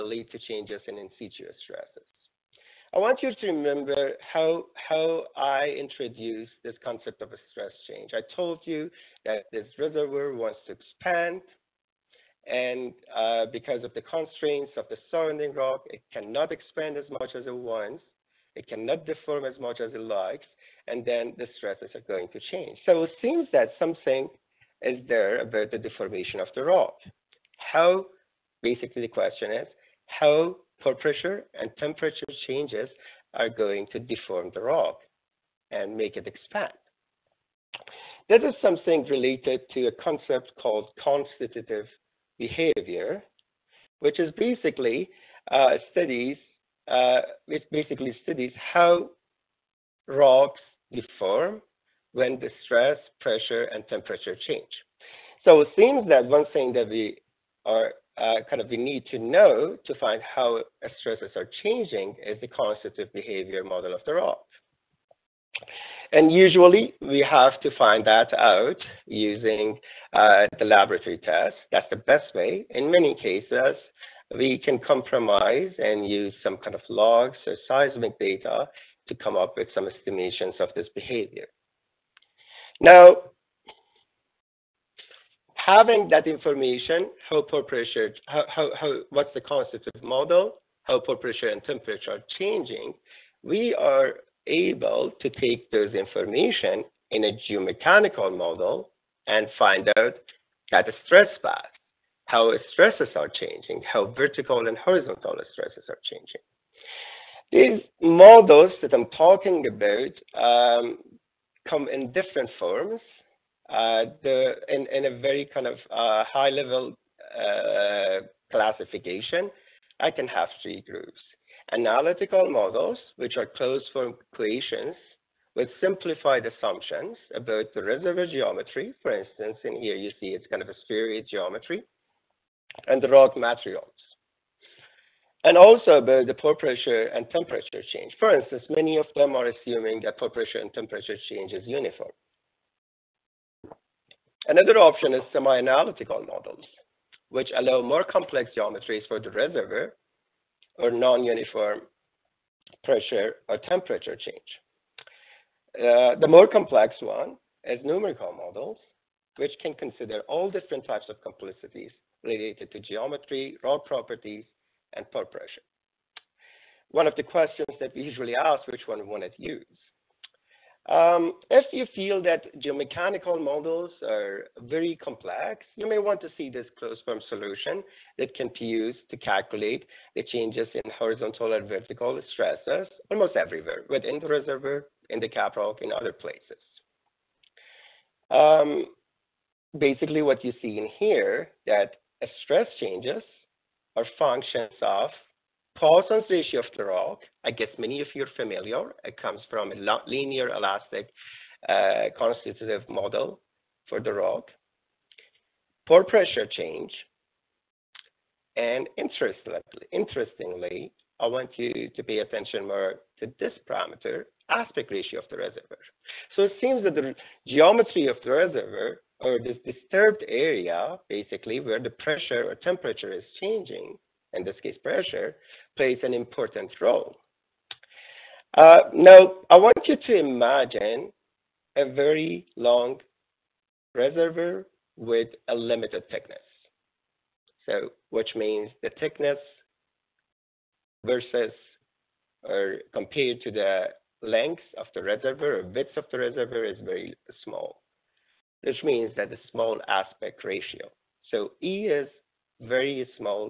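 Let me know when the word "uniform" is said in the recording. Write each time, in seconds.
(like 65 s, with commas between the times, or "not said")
141 s, 150 s.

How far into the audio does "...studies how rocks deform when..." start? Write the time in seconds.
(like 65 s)
48 s.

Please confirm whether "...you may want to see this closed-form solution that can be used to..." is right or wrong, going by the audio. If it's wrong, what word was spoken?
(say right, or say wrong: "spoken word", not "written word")
right.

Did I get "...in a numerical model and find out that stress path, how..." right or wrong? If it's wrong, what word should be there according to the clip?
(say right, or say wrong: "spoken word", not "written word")
wrong: "geomechanical", not "numerical".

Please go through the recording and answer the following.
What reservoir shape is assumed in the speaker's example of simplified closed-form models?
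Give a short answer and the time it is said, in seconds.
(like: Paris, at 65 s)
Spheroid, at 130 s.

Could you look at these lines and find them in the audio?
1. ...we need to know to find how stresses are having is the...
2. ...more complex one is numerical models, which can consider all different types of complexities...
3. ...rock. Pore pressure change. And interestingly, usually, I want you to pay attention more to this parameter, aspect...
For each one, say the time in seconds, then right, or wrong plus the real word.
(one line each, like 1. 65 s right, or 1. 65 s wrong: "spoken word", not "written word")
1. 58 s wrong: "changing", not "having"
2. 156 s right
3. 204 s wrong: "interestingly", not "usually".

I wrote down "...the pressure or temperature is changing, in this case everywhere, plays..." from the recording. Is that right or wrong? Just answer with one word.
wrong.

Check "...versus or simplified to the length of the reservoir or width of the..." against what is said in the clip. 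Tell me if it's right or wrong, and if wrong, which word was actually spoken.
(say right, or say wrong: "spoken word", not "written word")
wrong: "compared", not "simplified".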